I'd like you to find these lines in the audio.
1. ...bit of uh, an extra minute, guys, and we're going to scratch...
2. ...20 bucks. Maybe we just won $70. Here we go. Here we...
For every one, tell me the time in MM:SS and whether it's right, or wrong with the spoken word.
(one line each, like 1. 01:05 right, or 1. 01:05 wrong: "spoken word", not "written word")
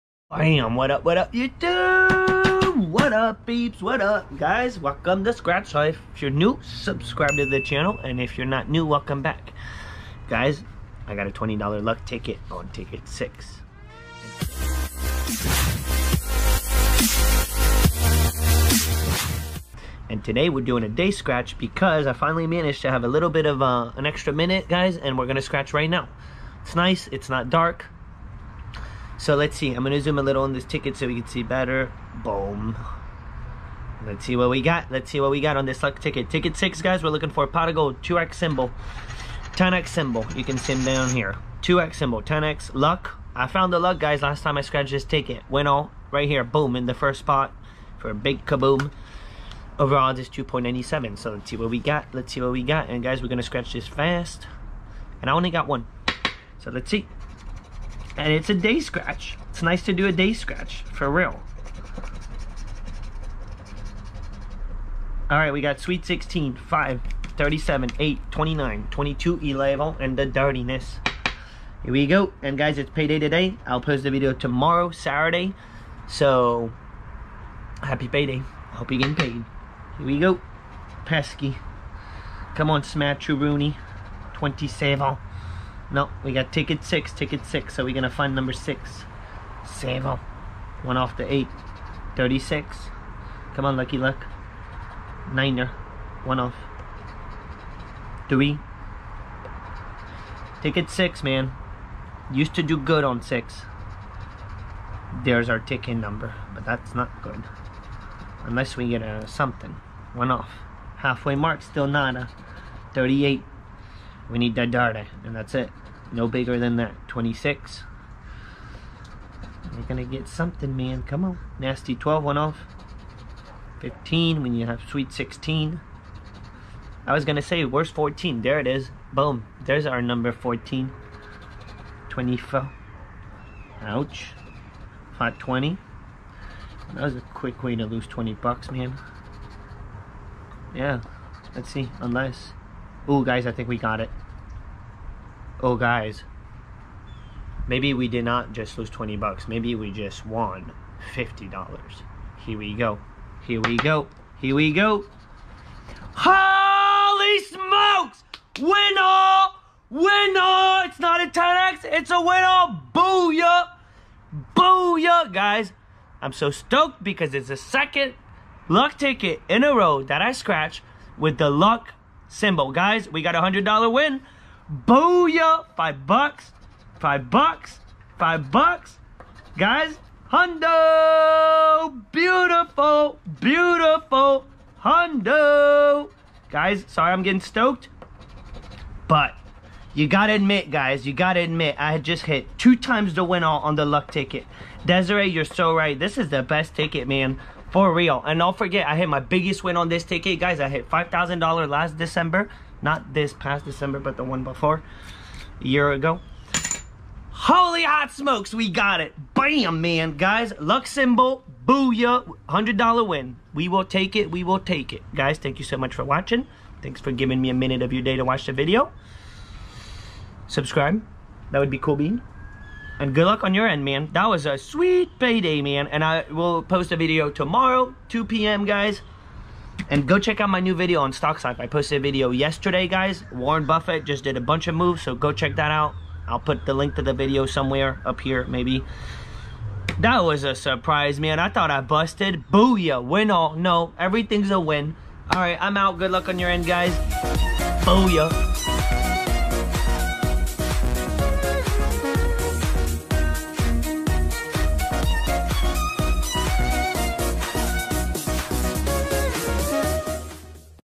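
1. 00:23 right
2. 02:28 wrong: "50", not "70".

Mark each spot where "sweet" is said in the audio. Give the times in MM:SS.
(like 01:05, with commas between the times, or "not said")
01:05, 02:04, 03:44.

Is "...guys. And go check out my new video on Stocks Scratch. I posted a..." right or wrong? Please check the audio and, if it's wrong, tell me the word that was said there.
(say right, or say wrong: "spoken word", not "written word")
wrong: "Life", not "Scratch".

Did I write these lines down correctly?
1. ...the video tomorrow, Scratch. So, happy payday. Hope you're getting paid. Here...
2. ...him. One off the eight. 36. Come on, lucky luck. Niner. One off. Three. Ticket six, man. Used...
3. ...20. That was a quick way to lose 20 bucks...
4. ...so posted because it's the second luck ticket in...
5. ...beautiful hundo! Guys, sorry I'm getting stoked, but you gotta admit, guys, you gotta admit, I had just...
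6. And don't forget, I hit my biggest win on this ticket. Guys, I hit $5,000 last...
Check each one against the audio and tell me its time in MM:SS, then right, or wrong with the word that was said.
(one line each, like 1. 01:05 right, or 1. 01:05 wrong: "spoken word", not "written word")
1. 01:14 wrong: "Saturday", not "Scratch"
2. 01:30 right
3. 02:15 right
4. 02:46 wrong: "stoked", not "posted"
5. 03:03 right
6. 03:18 right.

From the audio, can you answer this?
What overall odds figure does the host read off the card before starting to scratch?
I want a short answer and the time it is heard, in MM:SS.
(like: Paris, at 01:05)
2.97, at 00:50.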